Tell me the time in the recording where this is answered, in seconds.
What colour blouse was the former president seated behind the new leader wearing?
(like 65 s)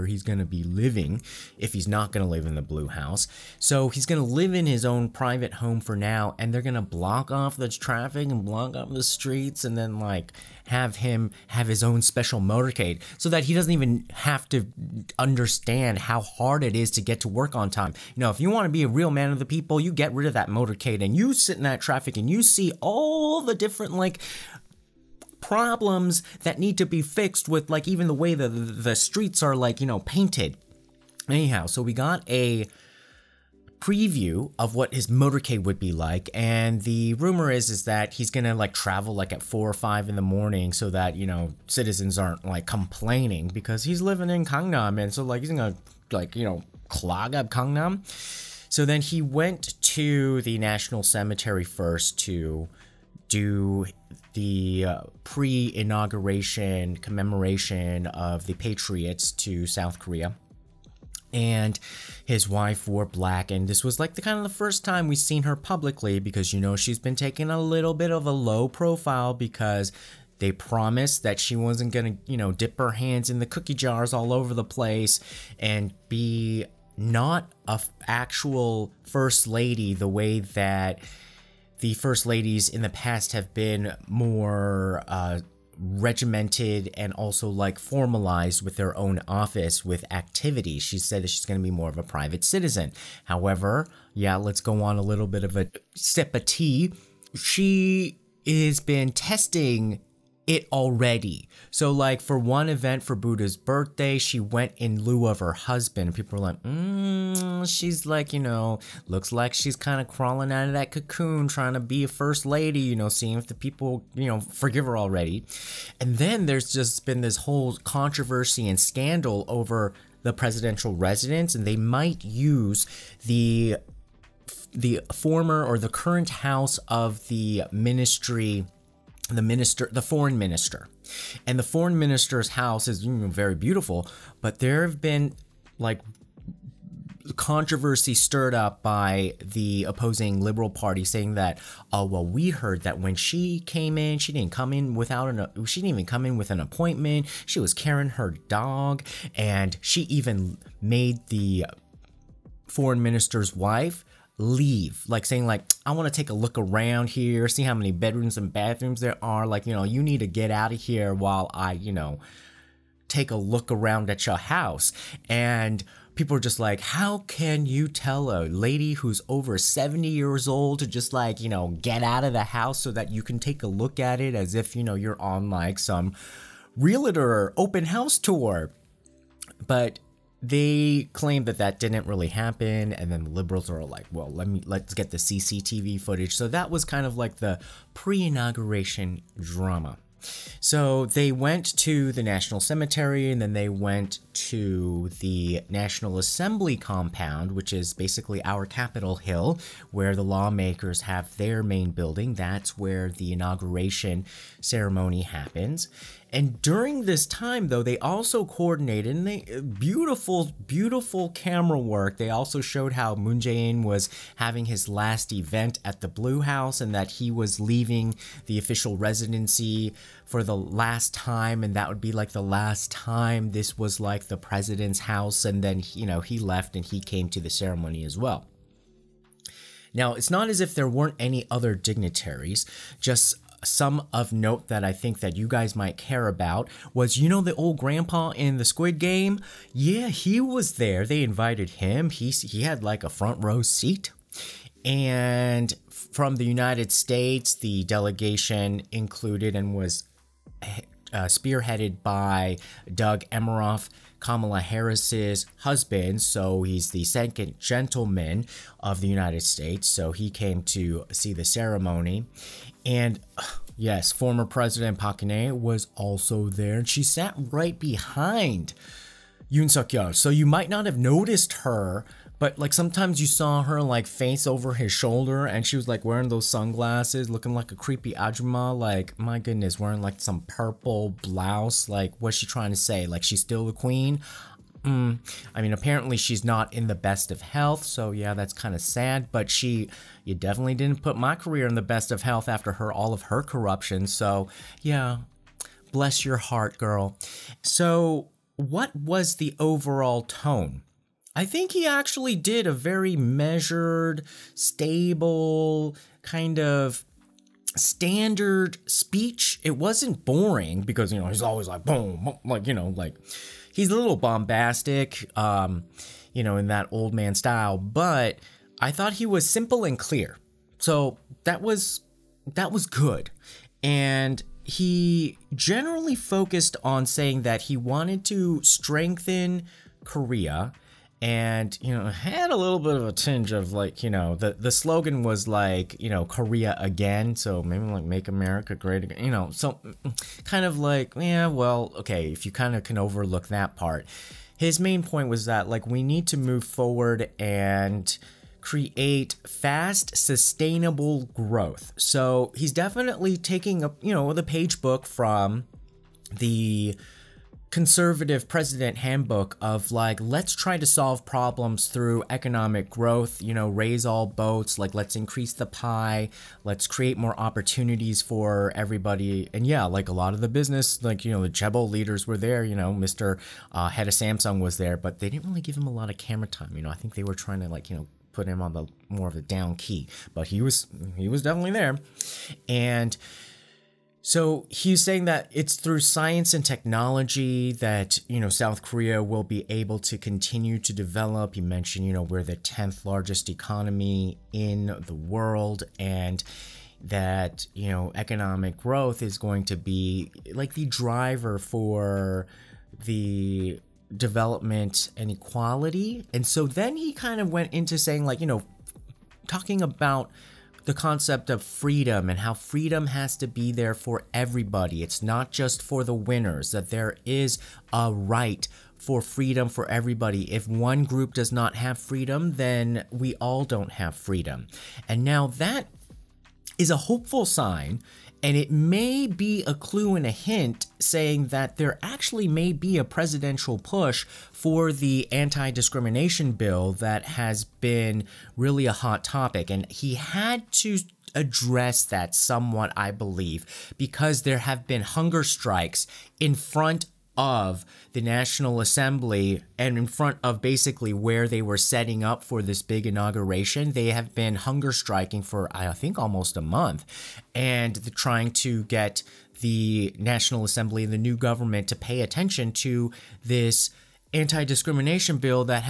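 280 s.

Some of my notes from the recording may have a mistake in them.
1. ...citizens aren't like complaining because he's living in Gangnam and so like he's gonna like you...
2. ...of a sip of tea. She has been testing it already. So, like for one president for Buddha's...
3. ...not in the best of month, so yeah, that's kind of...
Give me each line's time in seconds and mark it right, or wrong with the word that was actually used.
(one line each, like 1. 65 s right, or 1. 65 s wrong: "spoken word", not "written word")
1. 41 s right
2. 95 s wrong: "event", not "president"
3. 286 s wrong: "health", not "month".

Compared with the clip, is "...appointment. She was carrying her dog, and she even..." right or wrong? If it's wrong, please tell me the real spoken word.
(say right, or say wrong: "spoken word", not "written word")
right.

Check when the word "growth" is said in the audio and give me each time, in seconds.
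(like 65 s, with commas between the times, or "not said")
351 s, 362 s, 398 s.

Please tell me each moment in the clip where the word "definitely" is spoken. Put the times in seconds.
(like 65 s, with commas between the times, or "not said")
290 s, 352 s, 381 s.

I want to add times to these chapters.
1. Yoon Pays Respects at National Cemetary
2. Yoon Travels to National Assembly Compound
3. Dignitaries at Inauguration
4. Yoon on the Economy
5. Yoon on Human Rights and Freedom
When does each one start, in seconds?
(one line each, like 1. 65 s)
1. 50 s
2. 195 s
3. 230 s
4. 330 s
5. 405 s.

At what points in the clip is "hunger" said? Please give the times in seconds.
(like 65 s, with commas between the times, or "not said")
445 s, 454 s.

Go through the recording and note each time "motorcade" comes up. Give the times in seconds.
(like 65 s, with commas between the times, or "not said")
12 s, 20 s, 35 s.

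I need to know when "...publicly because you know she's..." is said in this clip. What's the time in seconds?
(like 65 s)
65 s.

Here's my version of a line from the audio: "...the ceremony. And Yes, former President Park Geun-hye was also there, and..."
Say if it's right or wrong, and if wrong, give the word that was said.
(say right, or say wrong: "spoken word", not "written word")
right.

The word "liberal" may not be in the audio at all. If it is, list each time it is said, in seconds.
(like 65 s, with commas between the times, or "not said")
140 s, 183 s.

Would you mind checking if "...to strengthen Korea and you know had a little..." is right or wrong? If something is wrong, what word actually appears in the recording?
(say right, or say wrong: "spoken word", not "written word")
right.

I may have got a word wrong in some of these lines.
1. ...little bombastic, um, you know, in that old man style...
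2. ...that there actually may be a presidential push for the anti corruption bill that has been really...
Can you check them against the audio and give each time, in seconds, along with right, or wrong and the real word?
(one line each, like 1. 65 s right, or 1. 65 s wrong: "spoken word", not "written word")
1. 313 s right
2. 431 s wrong: "discrimination", not "corruption".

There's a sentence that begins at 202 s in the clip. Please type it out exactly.
That's where the inauguration ceremony happens.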